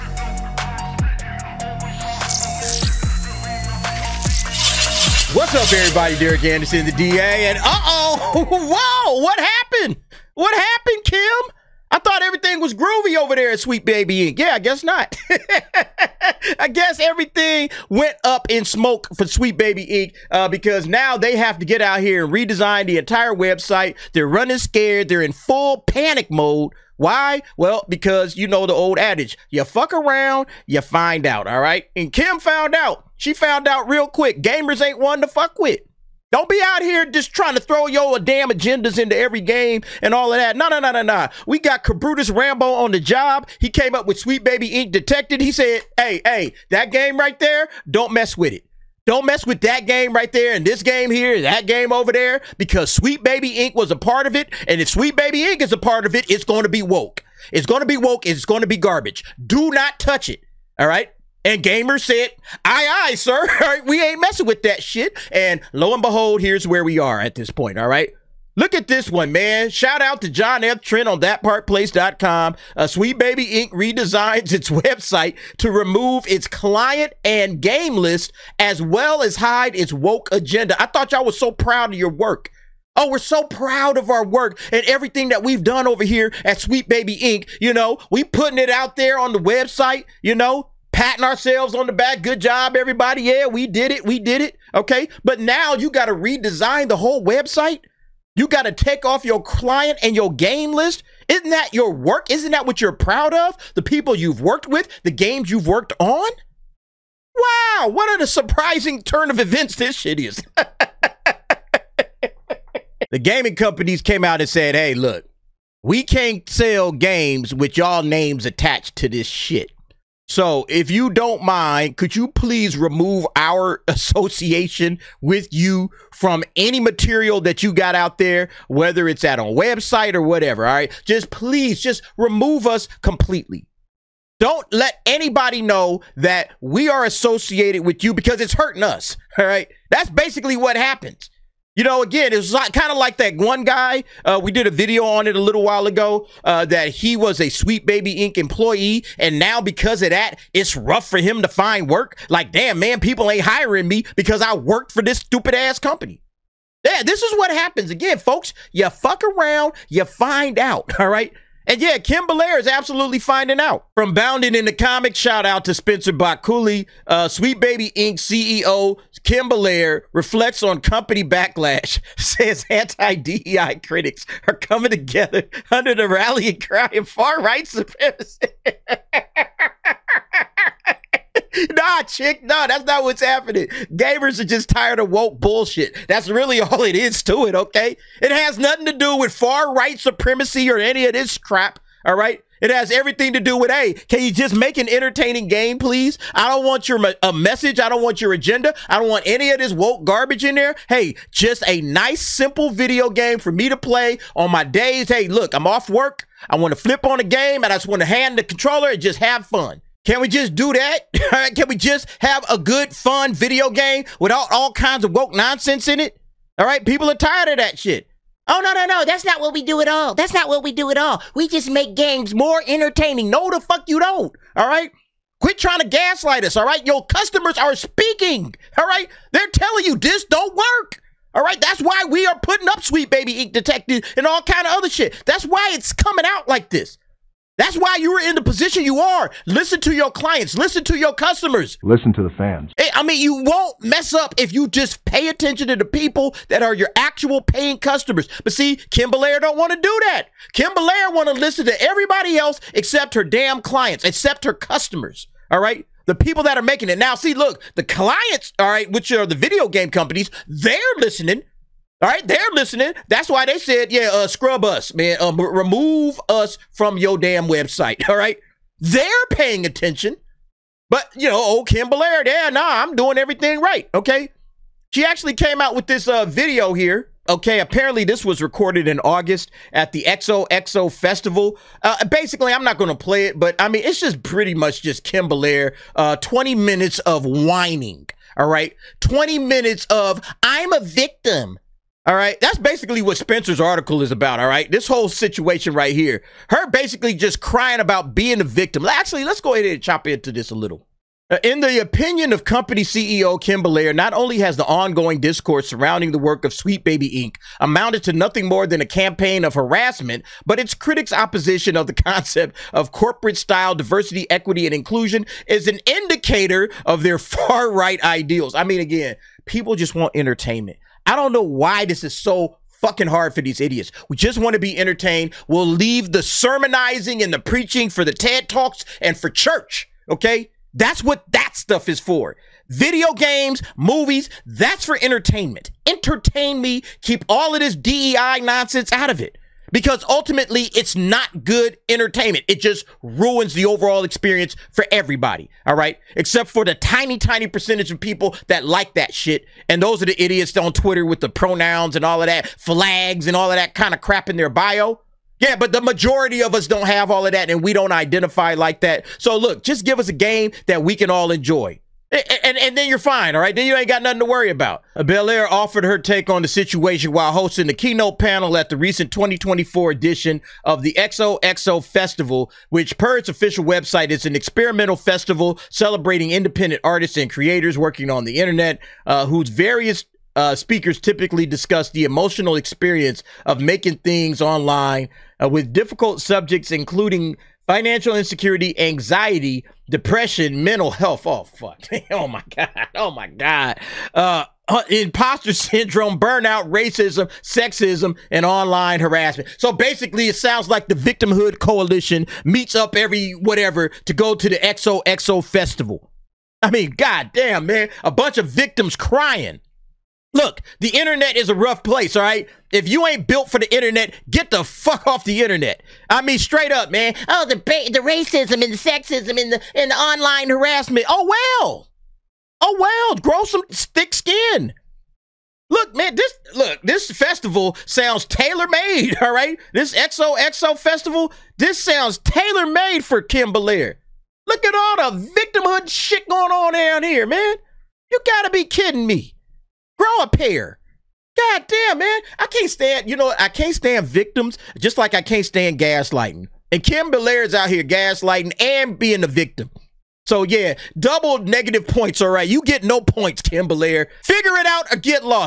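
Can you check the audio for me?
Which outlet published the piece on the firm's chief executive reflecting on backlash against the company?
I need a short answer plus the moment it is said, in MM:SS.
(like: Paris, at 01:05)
Bounding in the Comics, at 02:44.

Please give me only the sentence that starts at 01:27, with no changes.
You know, we putting it out there on the website, you know, patting ourselves on the back.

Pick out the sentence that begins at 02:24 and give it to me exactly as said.
Uh, we did a video on it a little while ago uh, that he was a Sweet Baby Inc.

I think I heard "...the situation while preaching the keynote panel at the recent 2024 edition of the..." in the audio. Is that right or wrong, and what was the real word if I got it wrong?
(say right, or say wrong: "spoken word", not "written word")
wrong: "hosting", not "preaching".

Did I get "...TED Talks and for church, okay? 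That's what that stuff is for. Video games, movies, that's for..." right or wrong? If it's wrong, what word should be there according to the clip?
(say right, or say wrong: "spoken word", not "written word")
right.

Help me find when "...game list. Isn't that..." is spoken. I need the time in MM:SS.
01:40.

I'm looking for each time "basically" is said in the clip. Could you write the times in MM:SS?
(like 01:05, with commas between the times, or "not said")
02:20, 04:42, 04:52, 04:56, 06:39.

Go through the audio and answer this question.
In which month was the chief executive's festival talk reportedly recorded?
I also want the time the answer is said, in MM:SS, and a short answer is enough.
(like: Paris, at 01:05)
August, at 04:39.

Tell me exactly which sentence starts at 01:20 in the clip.
I thought y'all was so proud of your work.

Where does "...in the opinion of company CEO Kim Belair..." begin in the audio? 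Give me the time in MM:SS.
05:01.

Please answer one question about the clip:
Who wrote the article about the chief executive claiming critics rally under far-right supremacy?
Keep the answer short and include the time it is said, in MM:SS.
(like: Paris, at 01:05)
Spencer Baculi, at 02:45.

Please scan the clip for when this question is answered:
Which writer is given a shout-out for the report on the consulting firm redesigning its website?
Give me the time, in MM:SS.
01:10.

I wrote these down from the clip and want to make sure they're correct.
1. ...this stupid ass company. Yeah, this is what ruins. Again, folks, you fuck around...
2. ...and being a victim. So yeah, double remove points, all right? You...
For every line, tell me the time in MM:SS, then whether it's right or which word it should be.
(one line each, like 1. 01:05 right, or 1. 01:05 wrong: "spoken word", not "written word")
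1. 02:35 wrong: "happens", not "ruins"
2. 07:28 wrong: "negative", not "remove".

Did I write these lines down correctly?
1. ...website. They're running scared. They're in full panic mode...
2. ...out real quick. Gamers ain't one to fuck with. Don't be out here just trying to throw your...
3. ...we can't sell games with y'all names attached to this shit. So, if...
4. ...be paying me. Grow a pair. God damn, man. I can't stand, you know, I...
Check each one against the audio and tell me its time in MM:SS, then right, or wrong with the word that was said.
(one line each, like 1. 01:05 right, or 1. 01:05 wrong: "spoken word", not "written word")
1. 00:23 right
2. 00:33 right
3. 01:55 right
4. 07:18 wrong: "kidding", not "paying".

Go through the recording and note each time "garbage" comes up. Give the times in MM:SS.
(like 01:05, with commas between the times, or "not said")
00:58, 03:20.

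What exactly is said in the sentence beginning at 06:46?
I mean, goddamn, man, a bunch of victims crying.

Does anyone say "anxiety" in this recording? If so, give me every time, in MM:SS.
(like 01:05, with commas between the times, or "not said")
06:28.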